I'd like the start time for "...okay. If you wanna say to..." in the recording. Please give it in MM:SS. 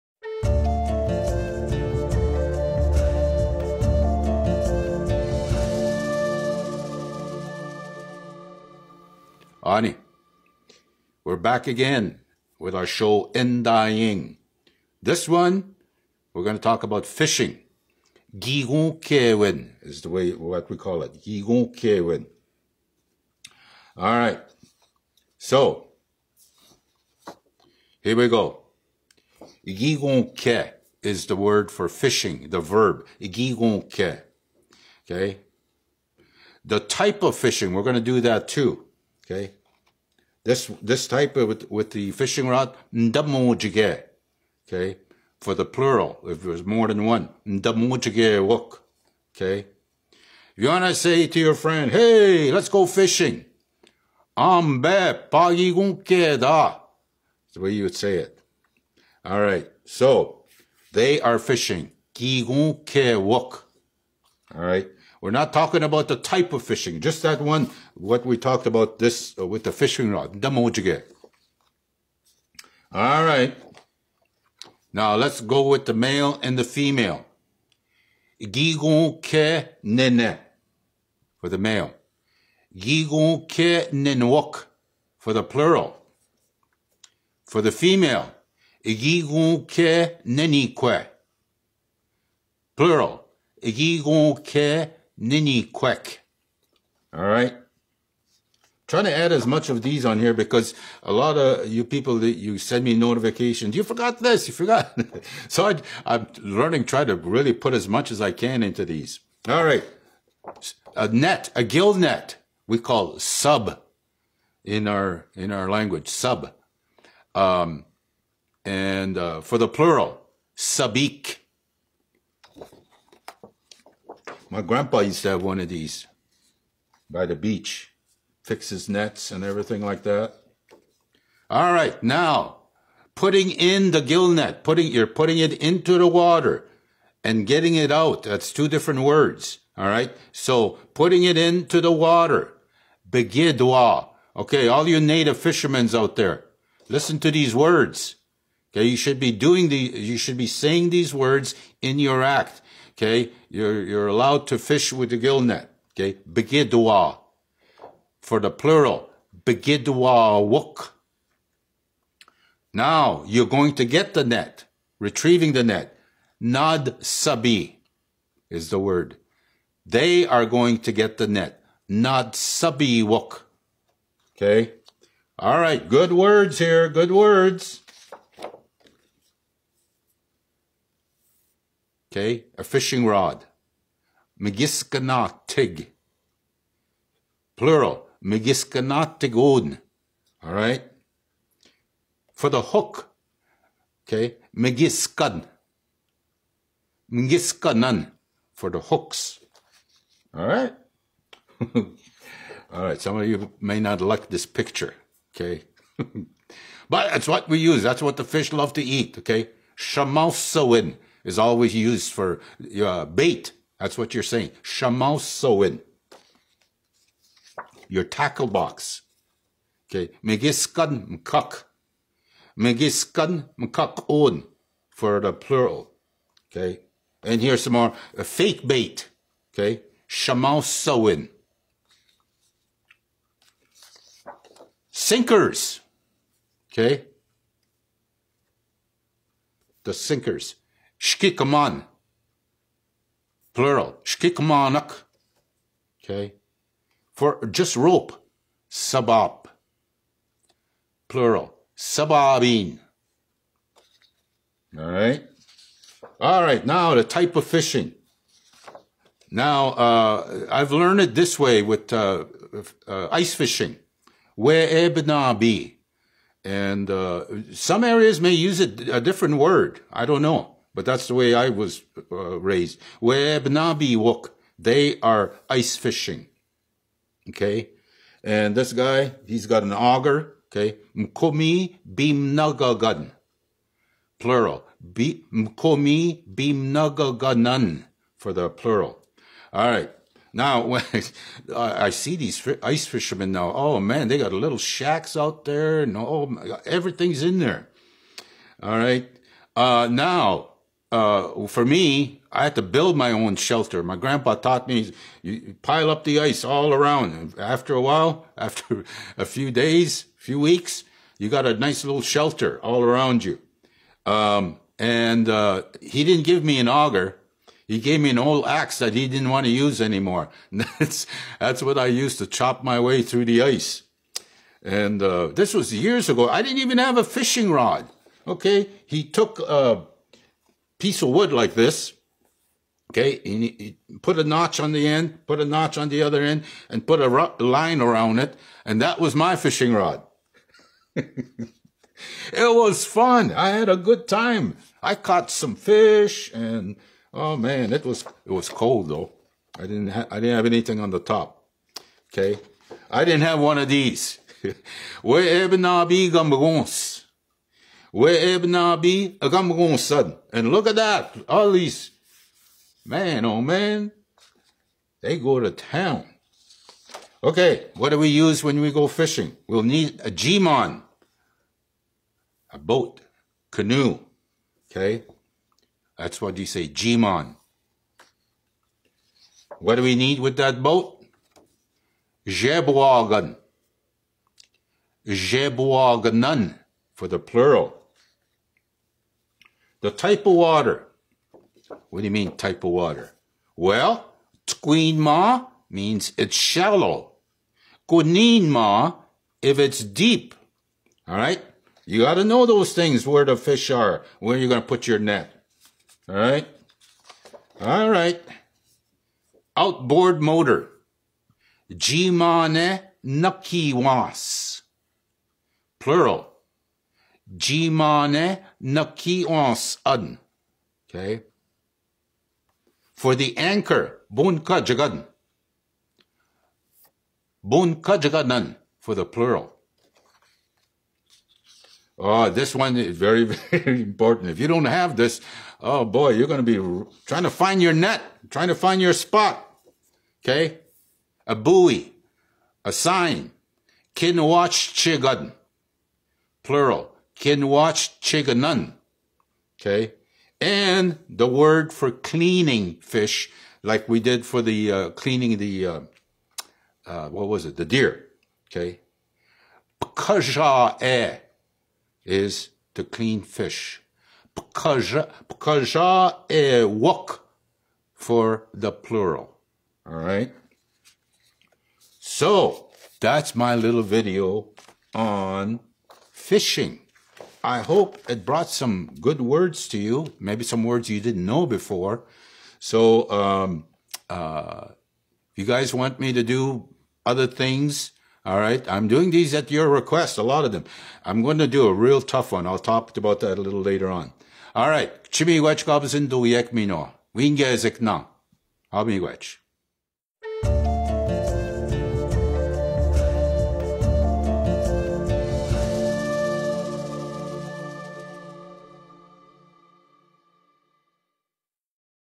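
00:49.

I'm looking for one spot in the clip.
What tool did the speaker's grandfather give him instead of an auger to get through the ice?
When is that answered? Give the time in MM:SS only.
05:18.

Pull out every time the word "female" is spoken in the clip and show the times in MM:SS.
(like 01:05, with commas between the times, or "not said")
01:16, 01:27.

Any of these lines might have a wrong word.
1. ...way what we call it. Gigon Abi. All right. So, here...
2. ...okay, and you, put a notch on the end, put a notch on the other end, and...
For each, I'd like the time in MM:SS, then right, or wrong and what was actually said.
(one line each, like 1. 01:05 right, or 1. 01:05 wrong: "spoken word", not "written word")
1. 00:20 wrong: "Kewin", not "Abi"
2. 05:32 right.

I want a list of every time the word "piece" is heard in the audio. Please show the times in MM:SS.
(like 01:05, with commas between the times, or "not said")
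05:30.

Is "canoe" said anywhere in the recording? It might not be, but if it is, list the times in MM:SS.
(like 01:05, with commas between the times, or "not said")
06:13.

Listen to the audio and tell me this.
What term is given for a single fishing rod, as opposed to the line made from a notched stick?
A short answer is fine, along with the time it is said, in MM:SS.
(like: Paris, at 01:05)
Megiskanatig, at 03:04.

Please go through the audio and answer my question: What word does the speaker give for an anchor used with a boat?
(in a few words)
bunka jagadn.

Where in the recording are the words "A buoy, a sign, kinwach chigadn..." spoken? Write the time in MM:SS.
07:21.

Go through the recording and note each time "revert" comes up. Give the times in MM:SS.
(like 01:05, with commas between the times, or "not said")
not said.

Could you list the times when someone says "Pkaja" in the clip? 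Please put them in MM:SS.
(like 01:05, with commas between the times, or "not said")
07:39, 07:44.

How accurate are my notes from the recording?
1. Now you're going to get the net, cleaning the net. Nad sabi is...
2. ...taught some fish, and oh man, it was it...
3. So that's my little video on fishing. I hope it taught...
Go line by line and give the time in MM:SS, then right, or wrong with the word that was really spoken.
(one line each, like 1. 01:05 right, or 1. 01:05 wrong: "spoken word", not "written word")
1. 02:42 wrong: "retrieving", not "cleaning"
2. 05:44 wrong: "caught", not "taught"
3. 07:51 wrong: "brought", not "taught".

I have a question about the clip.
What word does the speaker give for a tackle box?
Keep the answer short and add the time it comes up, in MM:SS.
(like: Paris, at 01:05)
Megiskan mukak, at 03:40.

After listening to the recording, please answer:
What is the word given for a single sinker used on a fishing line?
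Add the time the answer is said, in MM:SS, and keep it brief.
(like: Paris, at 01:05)
Shkikman, at 04:01.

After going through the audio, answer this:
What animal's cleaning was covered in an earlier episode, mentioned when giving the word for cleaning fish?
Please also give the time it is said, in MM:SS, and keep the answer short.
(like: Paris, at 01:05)
deer, at 07:37.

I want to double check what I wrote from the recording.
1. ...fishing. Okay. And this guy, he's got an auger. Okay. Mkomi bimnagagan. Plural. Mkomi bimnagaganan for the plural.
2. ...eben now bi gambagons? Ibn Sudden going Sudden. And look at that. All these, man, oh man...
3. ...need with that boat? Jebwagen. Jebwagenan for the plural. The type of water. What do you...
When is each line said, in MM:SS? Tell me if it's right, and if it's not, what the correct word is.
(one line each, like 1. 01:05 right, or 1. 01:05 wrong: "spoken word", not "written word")
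1. 04:35 right
2. 05:55 wrong: "Abi", not "Sudden"
3. 06:19 right.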